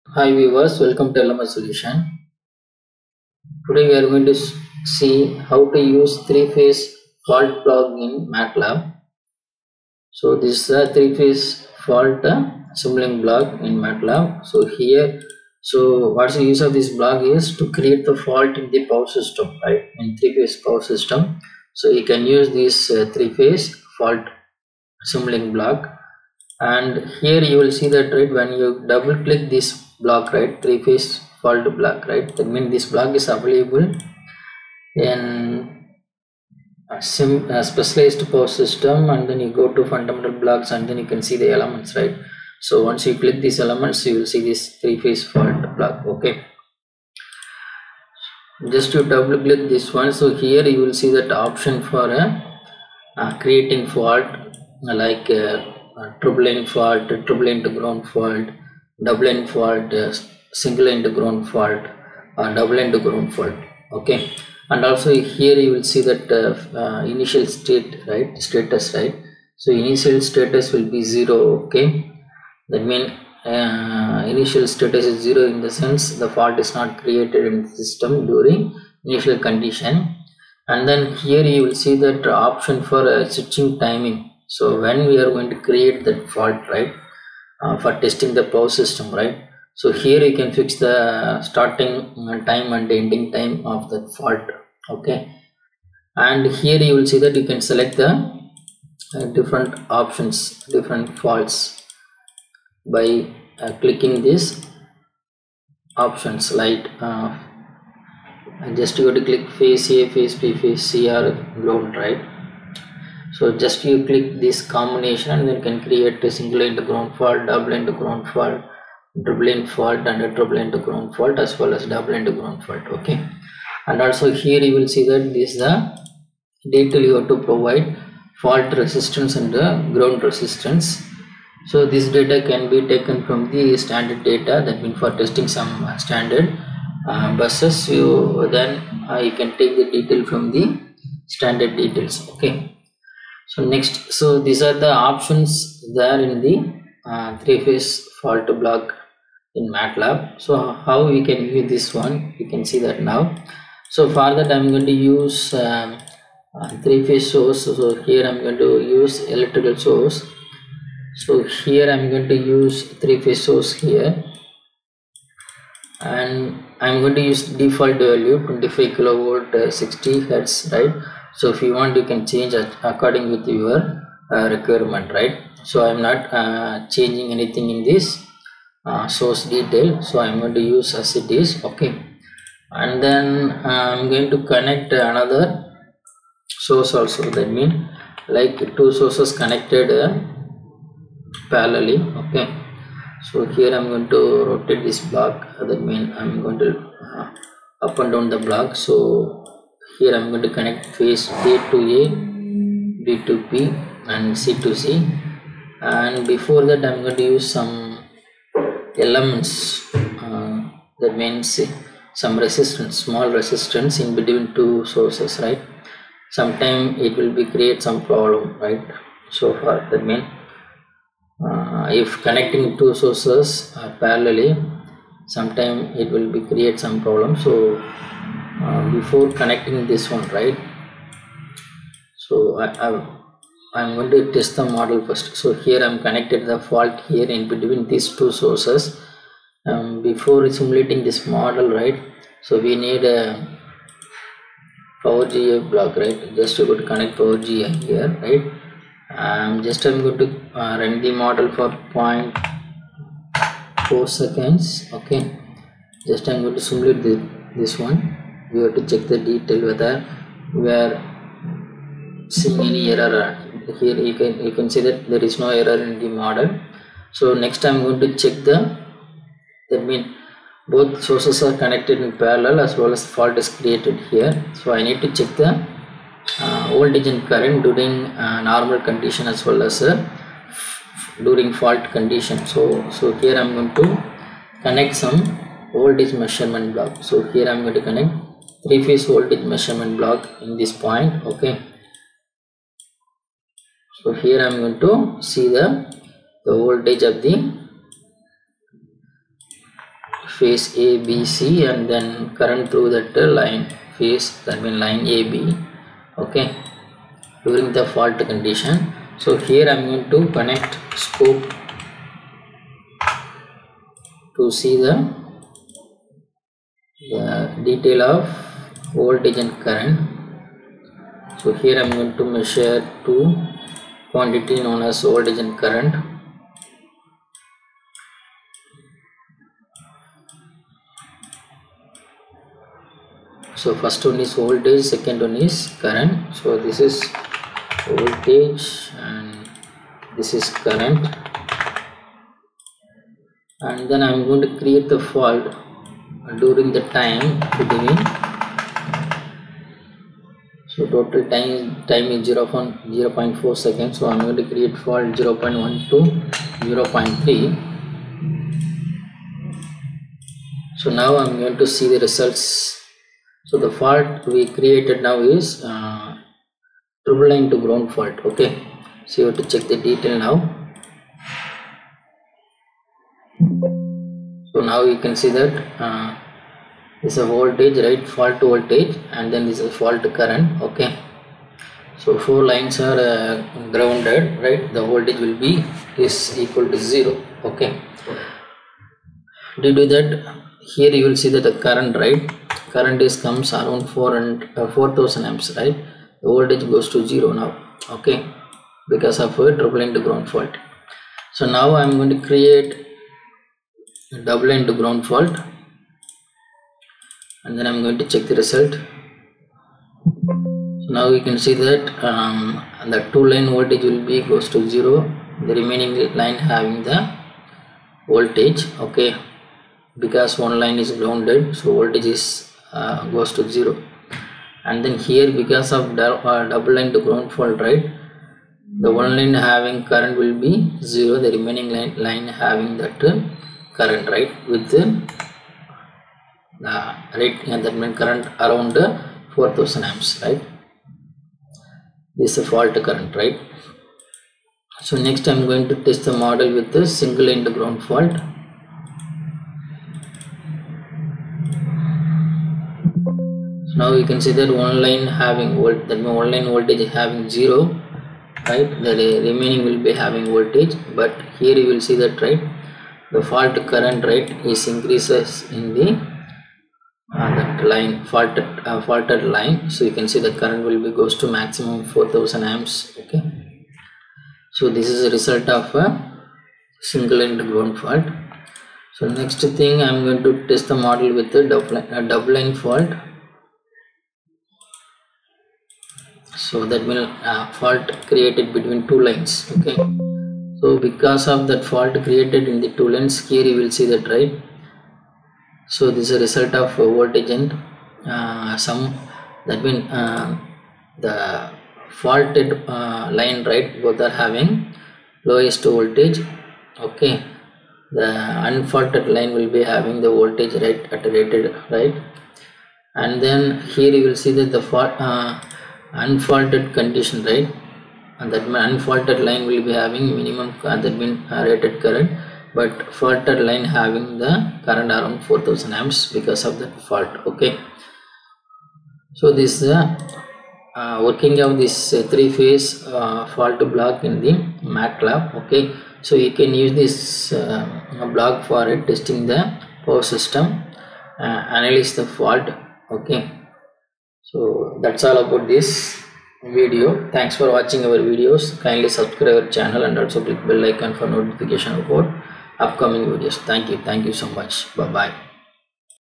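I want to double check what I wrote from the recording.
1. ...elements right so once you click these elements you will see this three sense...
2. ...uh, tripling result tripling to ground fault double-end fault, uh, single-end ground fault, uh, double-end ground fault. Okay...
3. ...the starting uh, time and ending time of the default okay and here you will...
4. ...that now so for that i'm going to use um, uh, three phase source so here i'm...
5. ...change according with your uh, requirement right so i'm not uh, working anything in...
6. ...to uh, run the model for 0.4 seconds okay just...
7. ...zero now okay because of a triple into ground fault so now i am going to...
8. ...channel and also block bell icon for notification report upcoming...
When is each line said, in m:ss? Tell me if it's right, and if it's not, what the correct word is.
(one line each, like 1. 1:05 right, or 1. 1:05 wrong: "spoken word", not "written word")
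1. 0:41 wrong: "phase", not "sense"
2. 0:56 wrong: "fault", not "result"
3. 1:30 wrong: "fault", not "default"
4. 2:32 right
5. 2:52 wrong: "changing", not "working"
6. 4:10 right
7. 6:37 right
8. 9:09 wrong: "click", not "block".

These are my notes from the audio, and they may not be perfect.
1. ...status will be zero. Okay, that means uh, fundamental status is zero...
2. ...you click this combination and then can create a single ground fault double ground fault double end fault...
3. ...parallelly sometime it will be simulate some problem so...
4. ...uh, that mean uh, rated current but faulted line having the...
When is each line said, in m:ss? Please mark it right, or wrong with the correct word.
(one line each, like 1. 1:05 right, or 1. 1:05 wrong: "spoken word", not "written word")
1. 1:10 wrong: "initial", not "fundamental"
2. 1:53 right
3. 3:43 wrong: "create", not "simulate"
4. 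8:40 right.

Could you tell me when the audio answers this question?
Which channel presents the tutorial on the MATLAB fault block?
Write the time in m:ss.
0:01.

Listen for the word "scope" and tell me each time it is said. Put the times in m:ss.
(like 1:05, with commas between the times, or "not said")
5:11.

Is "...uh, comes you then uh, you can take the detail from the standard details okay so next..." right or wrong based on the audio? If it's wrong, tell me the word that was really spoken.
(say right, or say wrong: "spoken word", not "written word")
wrong: "buses", not "comes".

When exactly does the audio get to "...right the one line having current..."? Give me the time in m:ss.
7:07.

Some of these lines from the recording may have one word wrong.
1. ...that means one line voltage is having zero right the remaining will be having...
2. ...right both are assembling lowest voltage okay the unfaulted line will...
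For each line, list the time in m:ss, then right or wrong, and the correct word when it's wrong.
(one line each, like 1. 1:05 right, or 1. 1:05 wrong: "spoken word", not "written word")
1. 7:35 right
2. 8:23 wrong: "having", not "assembling".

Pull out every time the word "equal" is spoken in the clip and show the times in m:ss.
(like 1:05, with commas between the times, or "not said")
6:26.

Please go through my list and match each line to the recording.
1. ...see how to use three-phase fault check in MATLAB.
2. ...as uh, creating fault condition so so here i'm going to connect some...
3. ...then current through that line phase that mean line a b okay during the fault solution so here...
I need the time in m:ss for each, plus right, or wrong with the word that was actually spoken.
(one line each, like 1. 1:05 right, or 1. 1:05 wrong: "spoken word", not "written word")
1. 0:04 wrong: "block", not "check"
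2. 4:39 wrong: "during", not "creating"
3. 5:01 wrong: "condition", not "solution".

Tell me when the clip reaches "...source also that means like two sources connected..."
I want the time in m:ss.
3:06.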